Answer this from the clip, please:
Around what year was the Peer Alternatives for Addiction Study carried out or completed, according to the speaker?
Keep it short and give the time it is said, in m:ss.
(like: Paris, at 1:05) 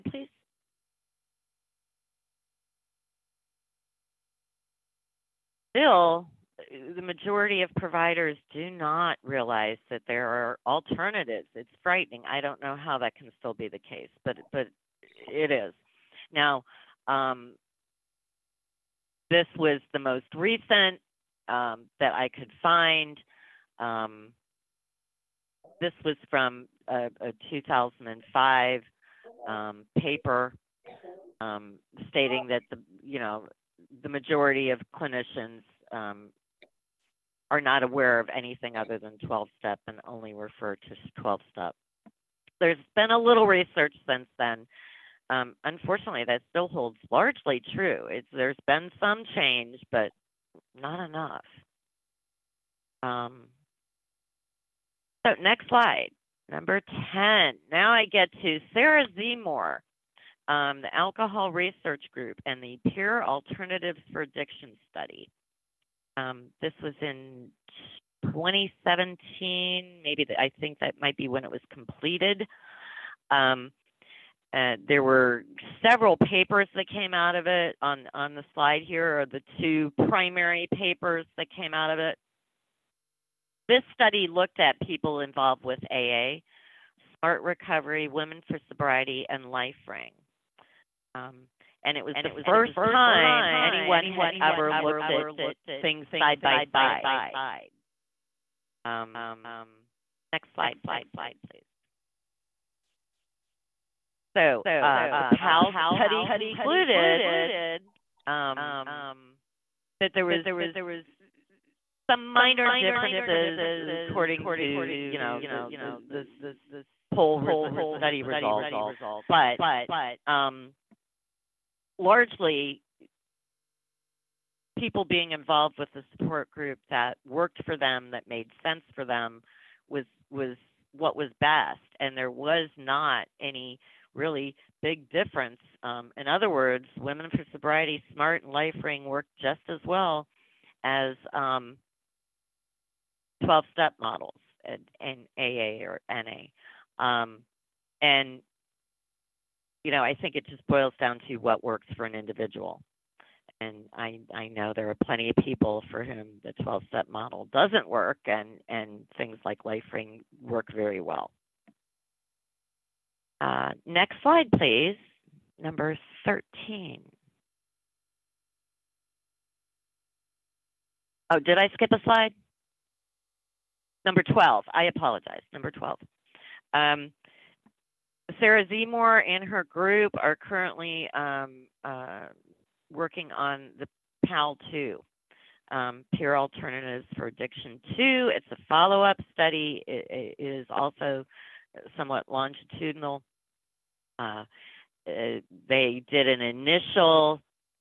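2017, at 1:08.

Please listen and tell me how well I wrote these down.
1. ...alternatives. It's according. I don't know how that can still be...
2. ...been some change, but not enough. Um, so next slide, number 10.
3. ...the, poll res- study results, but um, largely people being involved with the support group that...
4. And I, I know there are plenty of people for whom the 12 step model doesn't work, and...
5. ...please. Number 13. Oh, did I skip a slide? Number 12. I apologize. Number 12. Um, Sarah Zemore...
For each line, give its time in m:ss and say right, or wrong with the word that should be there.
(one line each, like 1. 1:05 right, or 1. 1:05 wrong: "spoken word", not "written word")
1. 0:10 wrong: "frightening", not "according"
2. 0:48 right
3. 1:56 right
4. 2:33 right
5. 2:44 right.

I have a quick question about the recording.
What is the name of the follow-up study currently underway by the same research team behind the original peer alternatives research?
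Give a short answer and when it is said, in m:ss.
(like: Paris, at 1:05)
PAL2, at 3:04.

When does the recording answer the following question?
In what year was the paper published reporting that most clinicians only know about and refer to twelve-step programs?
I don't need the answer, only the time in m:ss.
0:27.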